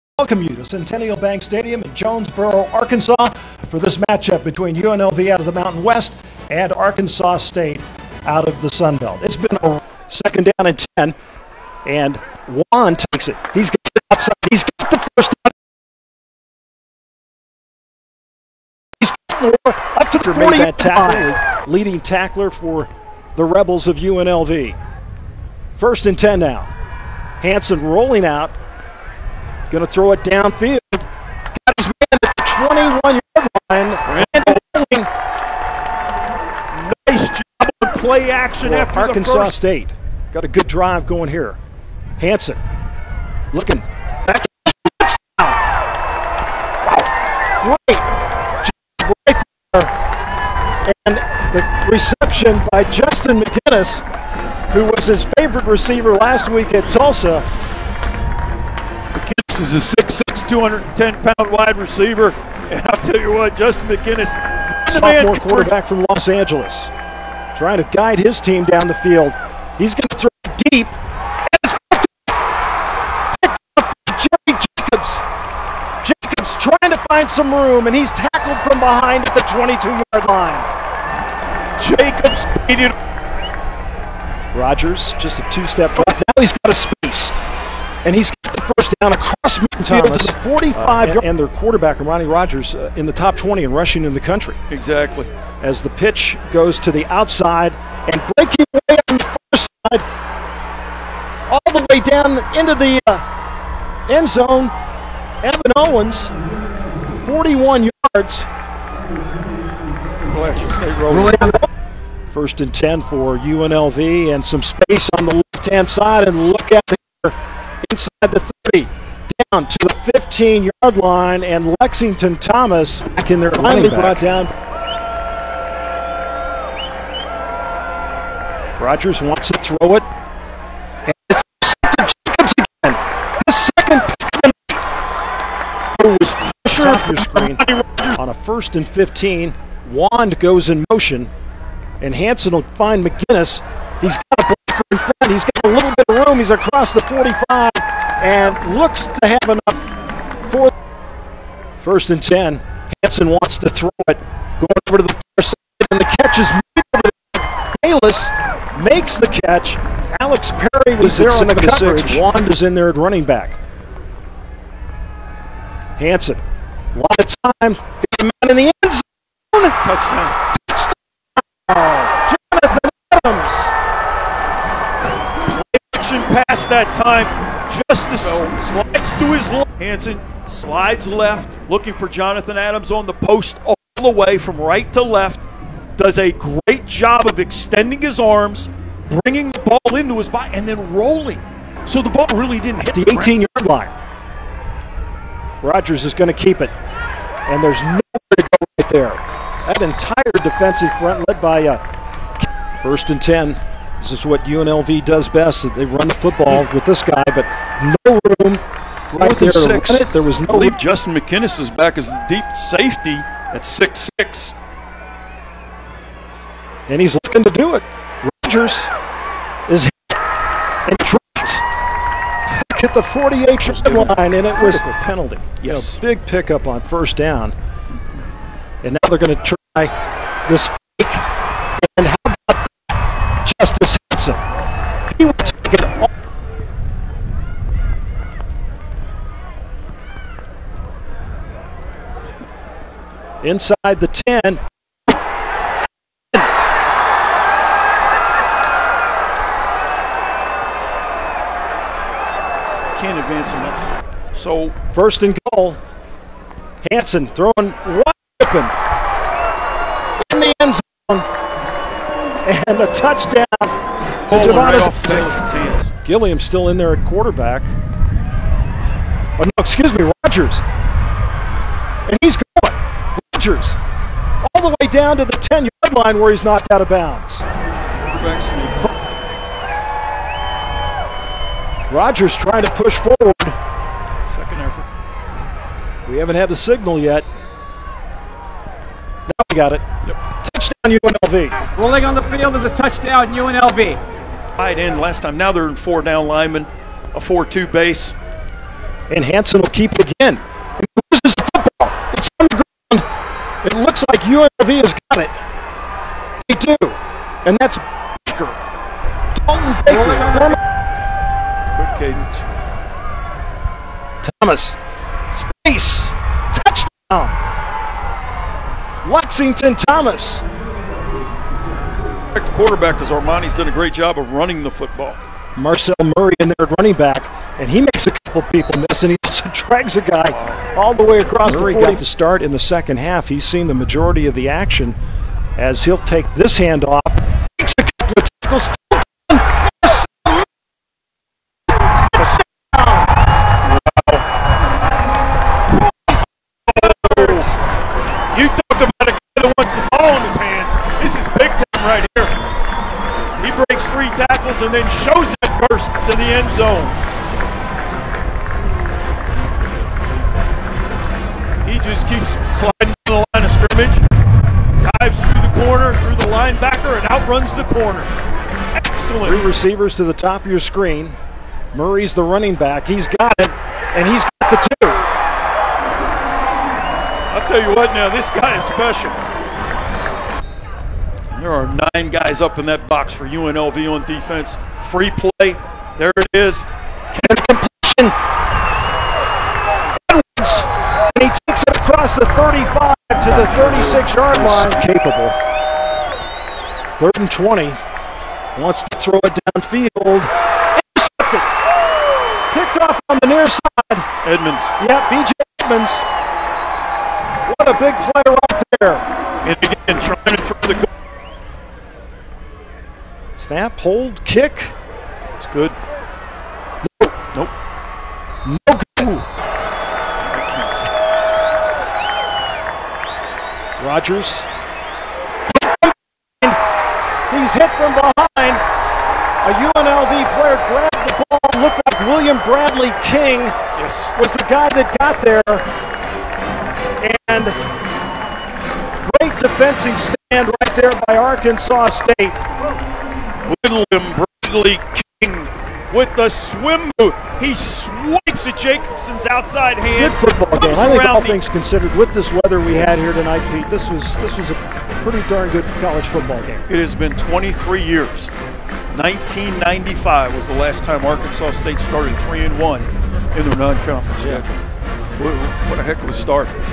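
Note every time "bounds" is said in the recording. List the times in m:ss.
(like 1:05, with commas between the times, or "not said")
4:36.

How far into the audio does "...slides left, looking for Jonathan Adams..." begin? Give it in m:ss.
3:00.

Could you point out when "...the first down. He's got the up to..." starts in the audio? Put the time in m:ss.
0:14.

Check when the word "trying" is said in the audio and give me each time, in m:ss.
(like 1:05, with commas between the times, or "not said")
1:07, 1:16, 4:42.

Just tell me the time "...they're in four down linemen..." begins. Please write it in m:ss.
4:55.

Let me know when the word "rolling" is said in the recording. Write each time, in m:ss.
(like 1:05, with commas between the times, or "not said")
0:27, 3:10, 4:51.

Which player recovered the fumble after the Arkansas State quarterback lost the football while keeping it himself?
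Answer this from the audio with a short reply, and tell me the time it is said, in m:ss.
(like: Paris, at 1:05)
Dalton Baker, at 5:09.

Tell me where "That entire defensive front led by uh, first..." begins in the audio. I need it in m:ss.
3:19.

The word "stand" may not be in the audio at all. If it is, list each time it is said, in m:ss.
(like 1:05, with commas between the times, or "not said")
7:20.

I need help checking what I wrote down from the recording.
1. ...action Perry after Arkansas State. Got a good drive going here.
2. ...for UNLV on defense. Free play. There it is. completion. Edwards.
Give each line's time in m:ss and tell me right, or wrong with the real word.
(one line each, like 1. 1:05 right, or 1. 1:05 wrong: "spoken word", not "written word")
1. 0:38 wrong: "For", not "Perry"
2. 6:23 right.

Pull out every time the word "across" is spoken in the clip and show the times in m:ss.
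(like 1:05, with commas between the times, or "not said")
2:26, 5:31, 6:31.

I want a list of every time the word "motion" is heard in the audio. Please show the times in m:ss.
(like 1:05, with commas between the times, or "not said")
2:20.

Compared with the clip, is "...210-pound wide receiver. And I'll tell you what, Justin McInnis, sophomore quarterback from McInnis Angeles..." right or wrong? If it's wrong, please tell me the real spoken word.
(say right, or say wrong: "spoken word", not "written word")
wrong: "Los", not "McInnis".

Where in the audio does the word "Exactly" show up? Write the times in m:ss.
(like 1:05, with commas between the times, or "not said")
1:34.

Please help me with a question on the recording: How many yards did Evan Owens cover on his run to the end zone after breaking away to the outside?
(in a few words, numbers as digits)
41.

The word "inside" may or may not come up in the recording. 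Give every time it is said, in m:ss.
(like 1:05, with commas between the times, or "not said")
1:57, 4:03.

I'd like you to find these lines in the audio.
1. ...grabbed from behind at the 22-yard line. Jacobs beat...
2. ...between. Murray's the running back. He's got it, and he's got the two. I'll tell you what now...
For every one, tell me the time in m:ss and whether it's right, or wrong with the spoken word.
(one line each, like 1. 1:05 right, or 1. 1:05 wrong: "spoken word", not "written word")
1. 1:18 wrong: "tackled", not "grabbed"
2. 6:10 wrong: "screen", not "between".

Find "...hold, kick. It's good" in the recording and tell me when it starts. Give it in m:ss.
6:53.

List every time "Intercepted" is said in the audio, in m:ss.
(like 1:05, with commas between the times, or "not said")
6:40.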